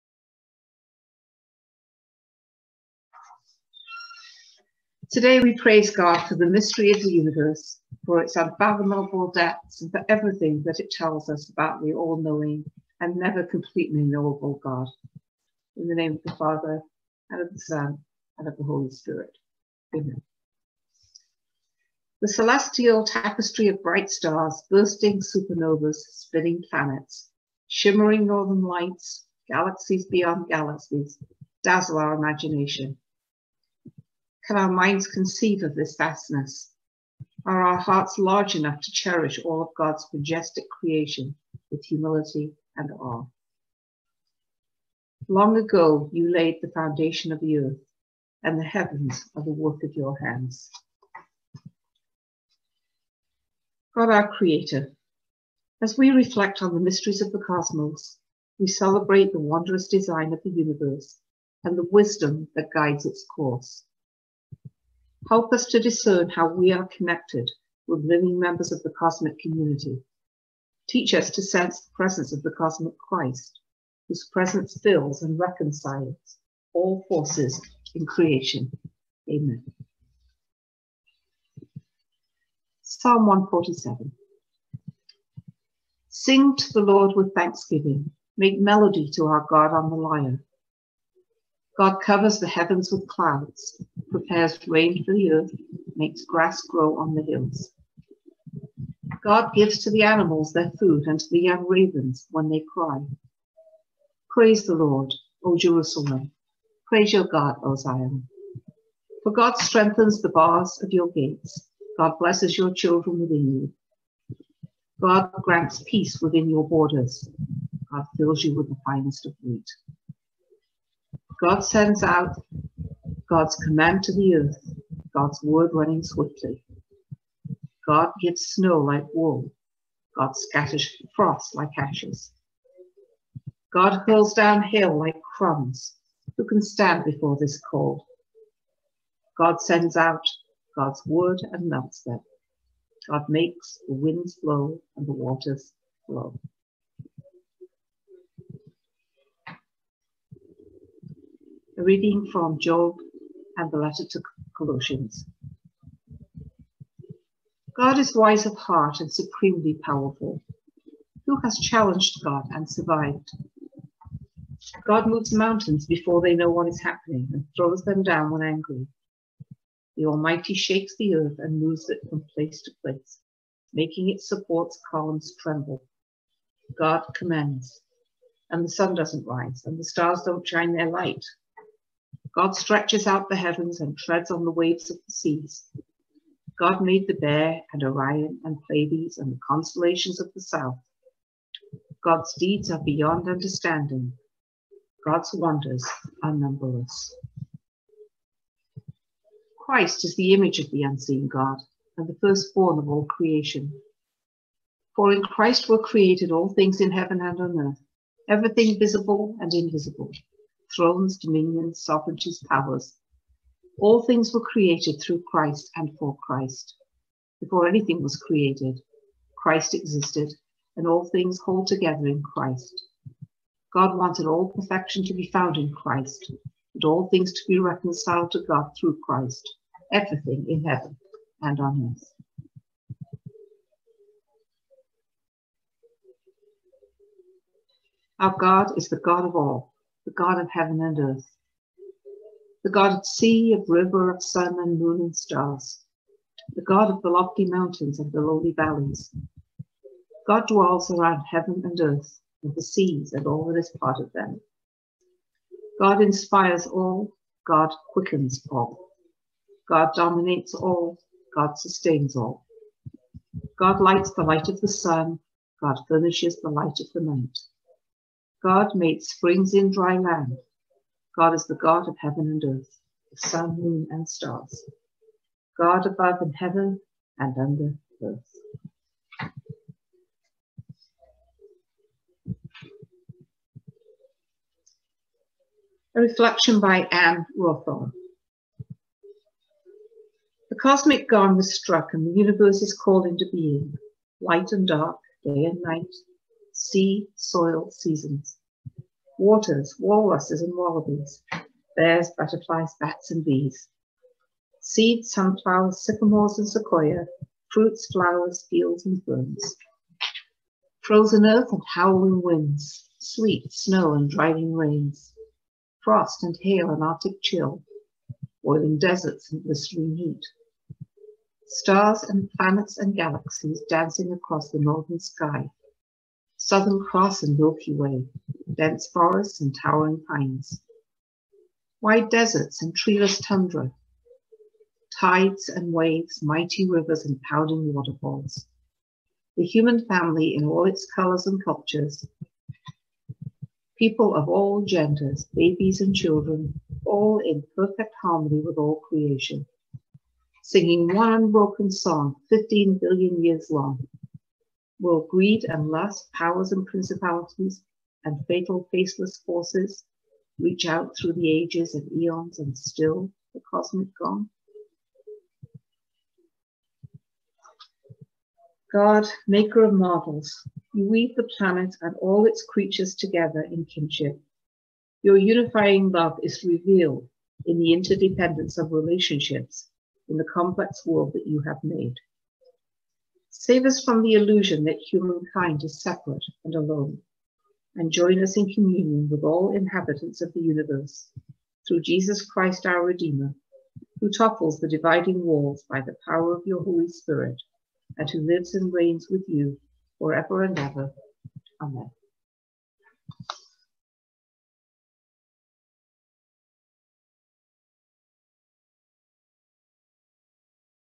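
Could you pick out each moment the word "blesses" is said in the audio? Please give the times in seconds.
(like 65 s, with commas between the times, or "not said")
112 s.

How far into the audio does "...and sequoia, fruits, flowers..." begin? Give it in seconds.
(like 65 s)
306 s.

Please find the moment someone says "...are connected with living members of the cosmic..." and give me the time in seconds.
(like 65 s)
66 s.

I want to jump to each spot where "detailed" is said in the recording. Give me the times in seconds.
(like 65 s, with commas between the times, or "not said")
not said.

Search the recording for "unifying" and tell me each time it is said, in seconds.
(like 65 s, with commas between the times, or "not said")
375 s.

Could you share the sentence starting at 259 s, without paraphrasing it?
God dominates all, God sustains all.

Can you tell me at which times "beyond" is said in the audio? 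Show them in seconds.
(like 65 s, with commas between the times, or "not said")
30 s, 192 s.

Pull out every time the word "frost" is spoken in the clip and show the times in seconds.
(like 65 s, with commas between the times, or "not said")
131 s, 315 s.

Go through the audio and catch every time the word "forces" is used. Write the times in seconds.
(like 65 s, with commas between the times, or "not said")
77 s, 359 s.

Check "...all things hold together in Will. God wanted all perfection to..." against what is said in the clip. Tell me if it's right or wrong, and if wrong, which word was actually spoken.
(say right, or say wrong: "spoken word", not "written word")
wrong: "Christ", not "Will".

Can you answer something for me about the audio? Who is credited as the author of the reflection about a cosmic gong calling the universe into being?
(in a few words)
Anne Rowthorn.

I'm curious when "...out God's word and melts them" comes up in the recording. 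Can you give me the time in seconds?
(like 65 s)
139 s.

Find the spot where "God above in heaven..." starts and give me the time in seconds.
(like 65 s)
275 s.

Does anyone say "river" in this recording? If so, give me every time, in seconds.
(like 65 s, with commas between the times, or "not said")
243 s, 336 s.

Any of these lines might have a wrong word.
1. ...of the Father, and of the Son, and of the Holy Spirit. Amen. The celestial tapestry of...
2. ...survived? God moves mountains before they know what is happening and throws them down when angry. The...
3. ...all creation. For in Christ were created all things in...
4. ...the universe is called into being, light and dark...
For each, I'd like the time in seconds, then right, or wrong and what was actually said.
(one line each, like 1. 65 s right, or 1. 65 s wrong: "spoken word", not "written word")
1. 16 s right
2. 162 s right
3. 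202 s right
4. 292 s right.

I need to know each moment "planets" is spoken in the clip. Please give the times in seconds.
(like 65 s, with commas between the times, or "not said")
26 s, 322 s, 371 s.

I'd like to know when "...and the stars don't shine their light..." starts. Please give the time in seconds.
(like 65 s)
179 s.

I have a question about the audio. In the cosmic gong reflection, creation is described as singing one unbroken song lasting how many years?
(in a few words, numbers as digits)
15 billion years.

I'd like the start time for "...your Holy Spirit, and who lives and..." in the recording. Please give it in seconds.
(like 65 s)
396 s.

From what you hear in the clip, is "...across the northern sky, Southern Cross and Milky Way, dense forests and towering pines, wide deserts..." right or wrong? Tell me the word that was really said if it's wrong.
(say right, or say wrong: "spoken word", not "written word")
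right.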